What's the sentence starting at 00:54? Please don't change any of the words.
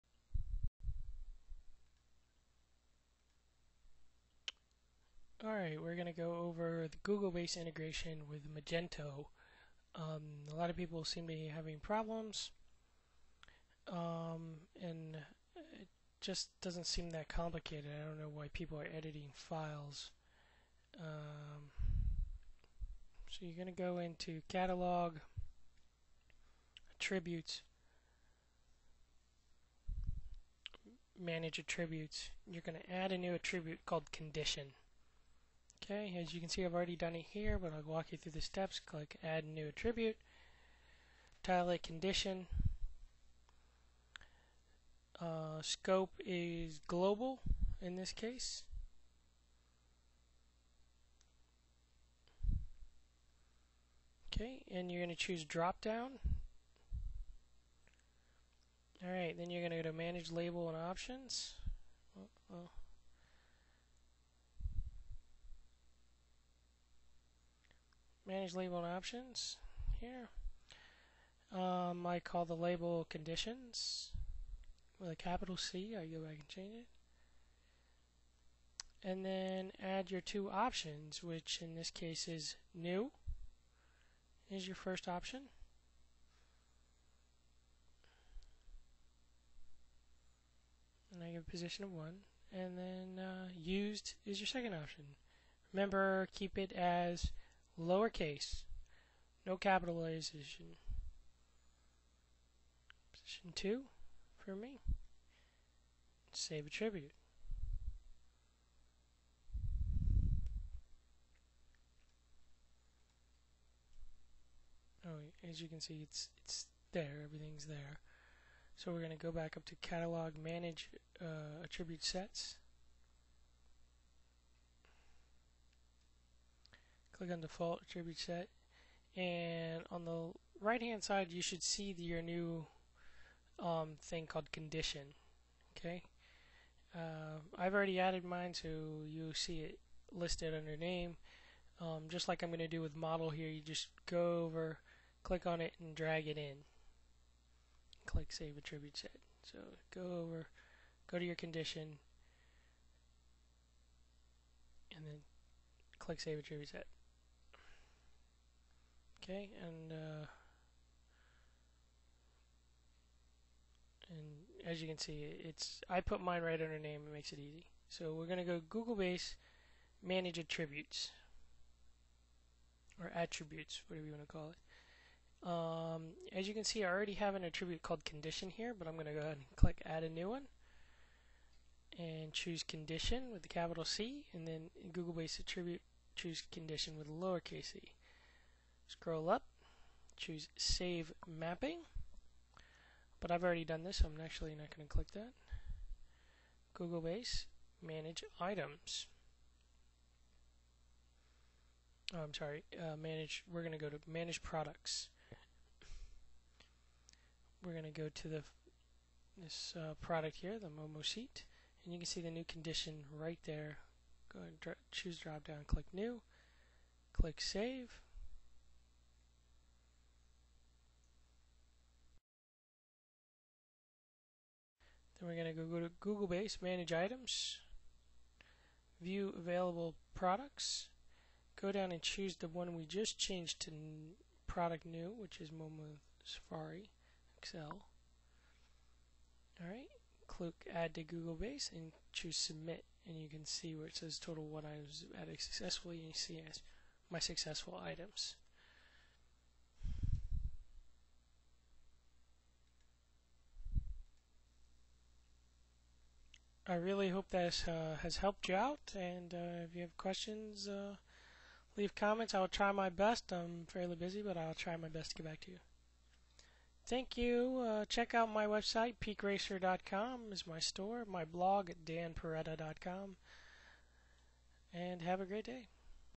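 Okay, and you're going to choose drop down.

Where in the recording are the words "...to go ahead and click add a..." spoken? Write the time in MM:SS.
02:59.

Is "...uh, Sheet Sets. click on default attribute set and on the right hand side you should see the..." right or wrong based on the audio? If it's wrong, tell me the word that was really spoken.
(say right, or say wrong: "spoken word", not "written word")
wrong: "Attribute", not "Sheet".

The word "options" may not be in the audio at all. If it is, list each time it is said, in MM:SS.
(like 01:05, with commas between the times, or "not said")
01:00, 01:08, 01:20, 01:25, 01:34.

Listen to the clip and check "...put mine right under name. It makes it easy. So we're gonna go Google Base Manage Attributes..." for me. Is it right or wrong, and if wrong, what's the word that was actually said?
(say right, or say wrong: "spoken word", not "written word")
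right.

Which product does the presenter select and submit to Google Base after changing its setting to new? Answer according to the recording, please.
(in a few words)
Momo Safari Excel.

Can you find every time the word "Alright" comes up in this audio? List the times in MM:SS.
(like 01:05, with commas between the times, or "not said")
00:05, 00:59, 03:59.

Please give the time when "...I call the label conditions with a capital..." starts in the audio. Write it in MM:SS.
01:12.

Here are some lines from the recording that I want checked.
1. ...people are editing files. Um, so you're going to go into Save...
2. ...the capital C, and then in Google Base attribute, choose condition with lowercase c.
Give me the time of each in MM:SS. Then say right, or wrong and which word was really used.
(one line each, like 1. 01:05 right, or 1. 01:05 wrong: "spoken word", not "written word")
1. 00:18 wrong: "Catalog", not "Save"
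2. 03:03 right.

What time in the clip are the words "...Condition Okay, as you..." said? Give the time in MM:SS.
00:34.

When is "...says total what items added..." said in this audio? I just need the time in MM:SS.
04:03.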